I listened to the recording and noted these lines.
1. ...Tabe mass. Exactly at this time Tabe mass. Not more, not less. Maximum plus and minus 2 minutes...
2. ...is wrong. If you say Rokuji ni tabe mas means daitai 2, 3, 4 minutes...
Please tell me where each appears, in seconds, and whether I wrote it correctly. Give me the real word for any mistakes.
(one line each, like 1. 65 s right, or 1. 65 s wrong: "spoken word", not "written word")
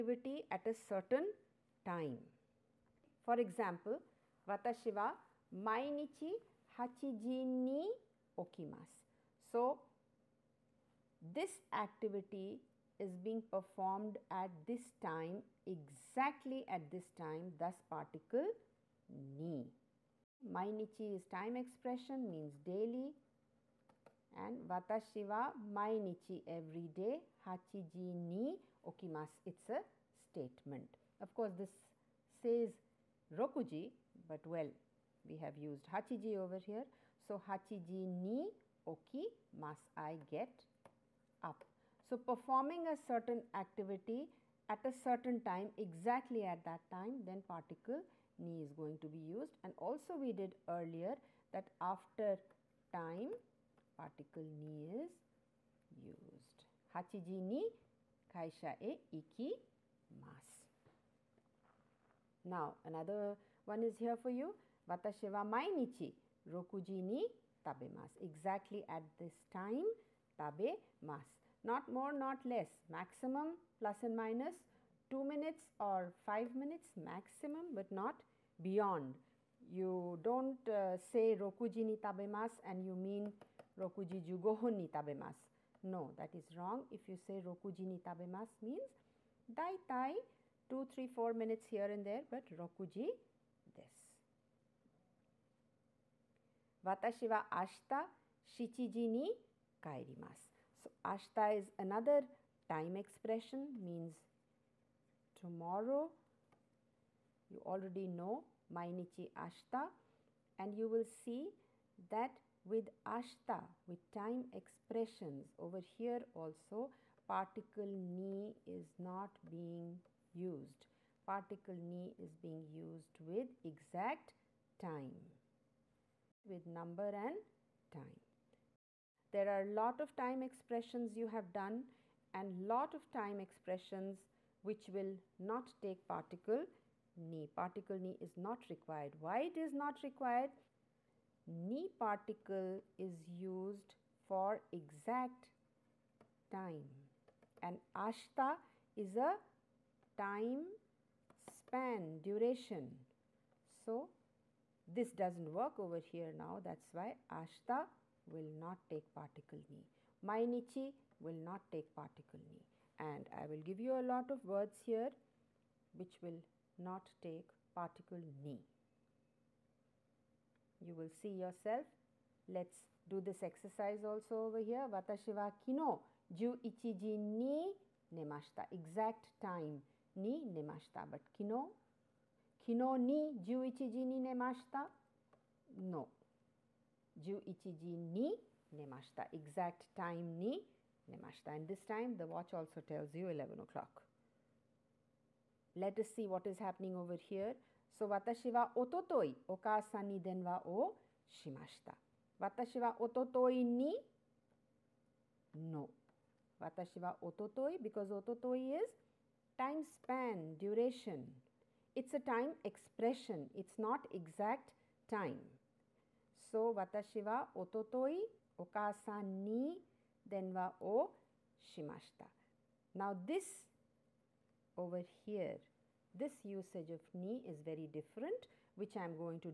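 1. 67 s right
2. 86 s right.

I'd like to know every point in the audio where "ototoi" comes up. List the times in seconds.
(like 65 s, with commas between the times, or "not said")
217 s.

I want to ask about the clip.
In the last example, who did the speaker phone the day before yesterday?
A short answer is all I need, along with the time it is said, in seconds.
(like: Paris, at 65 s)
okasan, at 218 s.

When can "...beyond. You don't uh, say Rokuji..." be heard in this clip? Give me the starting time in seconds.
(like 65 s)
78 s.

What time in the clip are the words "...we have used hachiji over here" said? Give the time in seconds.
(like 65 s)
35 s.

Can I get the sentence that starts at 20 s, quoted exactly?
Mainichi is time expression means daily and watashi wa mainichi every day hachiji ni okimasu it's a statement.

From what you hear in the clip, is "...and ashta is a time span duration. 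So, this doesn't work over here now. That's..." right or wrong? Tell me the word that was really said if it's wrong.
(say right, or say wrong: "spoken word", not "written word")
right.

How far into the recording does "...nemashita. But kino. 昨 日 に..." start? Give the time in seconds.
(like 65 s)
180 s.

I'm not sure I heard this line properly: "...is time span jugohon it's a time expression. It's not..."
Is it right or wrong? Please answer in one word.
wrong.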